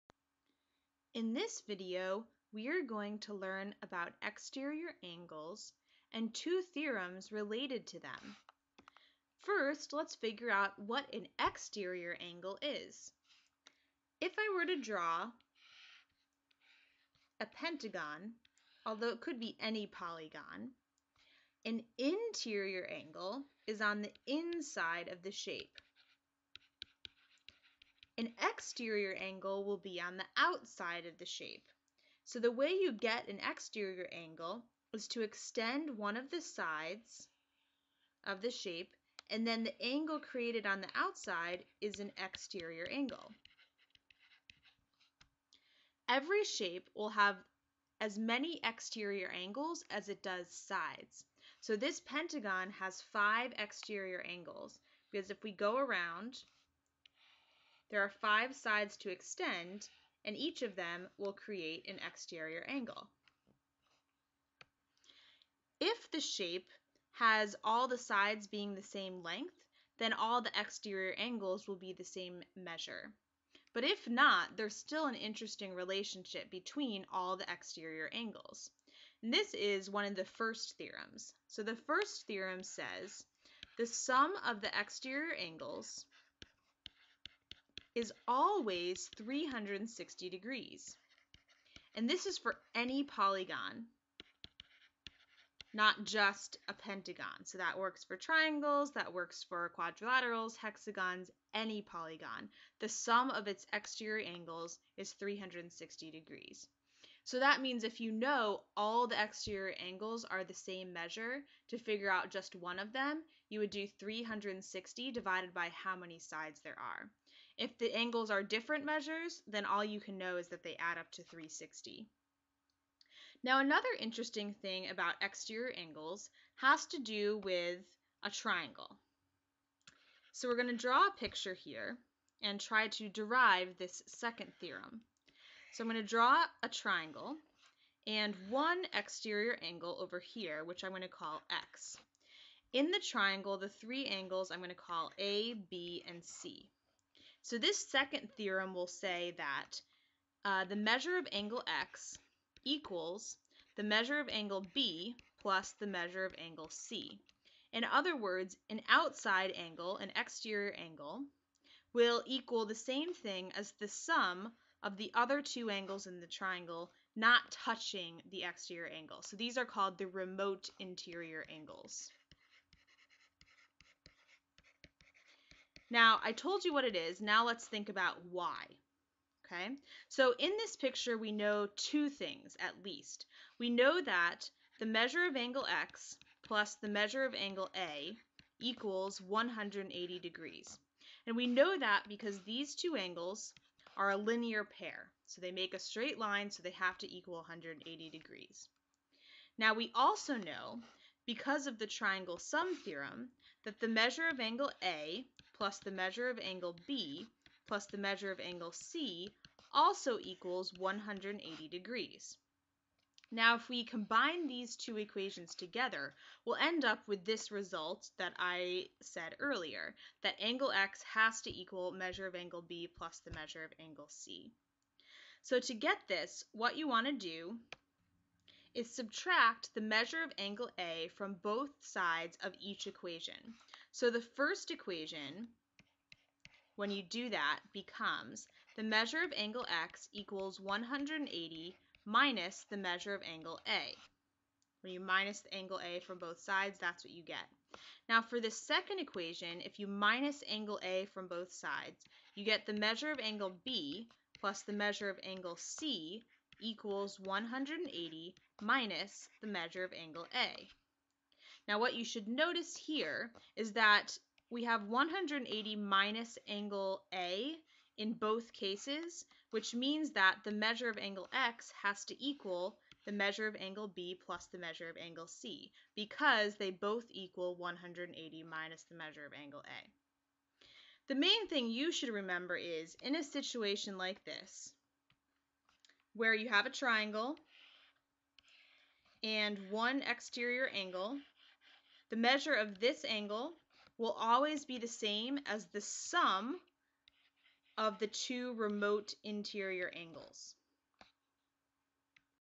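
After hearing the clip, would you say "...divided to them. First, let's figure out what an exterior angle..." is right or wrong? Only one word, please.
wrong.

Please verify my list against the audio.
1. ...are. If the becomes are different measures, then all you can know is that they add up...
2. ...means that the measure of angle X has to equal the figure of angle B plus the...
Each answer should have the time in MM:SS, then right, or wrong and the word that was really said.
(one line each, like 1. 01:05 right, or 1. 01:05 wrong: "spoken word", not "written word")
1. 01:56 wrong: "angles", not "becomes"
2. 04:29 wrong: "measure", not "figure".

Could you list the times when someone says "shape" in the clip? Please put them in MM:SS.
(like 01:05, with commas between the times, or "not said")
00:25, 00:31, 00:38, 00:46, 01:06.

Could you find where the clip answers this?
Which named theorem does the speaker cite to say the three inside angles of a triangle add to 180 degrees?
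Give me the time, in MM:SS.
03:21.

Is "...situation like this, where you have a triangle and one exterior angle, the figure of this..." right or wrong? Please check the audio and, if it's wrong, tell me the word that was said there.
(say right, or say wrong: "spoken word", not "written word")
wrong: "measure", not "figure".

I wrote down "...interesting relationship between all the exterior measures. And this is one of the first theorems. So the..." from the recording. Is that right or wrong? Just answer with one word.
wrong.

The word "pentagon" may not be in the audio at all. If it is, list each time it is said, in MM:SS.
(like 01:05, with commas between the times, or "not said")
00:17, 00:52, 01:36.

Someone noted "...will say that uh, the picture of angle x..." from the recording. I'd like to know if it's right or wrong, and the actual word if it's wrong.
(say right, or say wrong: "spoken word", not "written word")
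wrong: "measure", not "picture".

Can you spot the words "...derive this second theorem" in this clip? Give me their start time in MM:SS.
02:13.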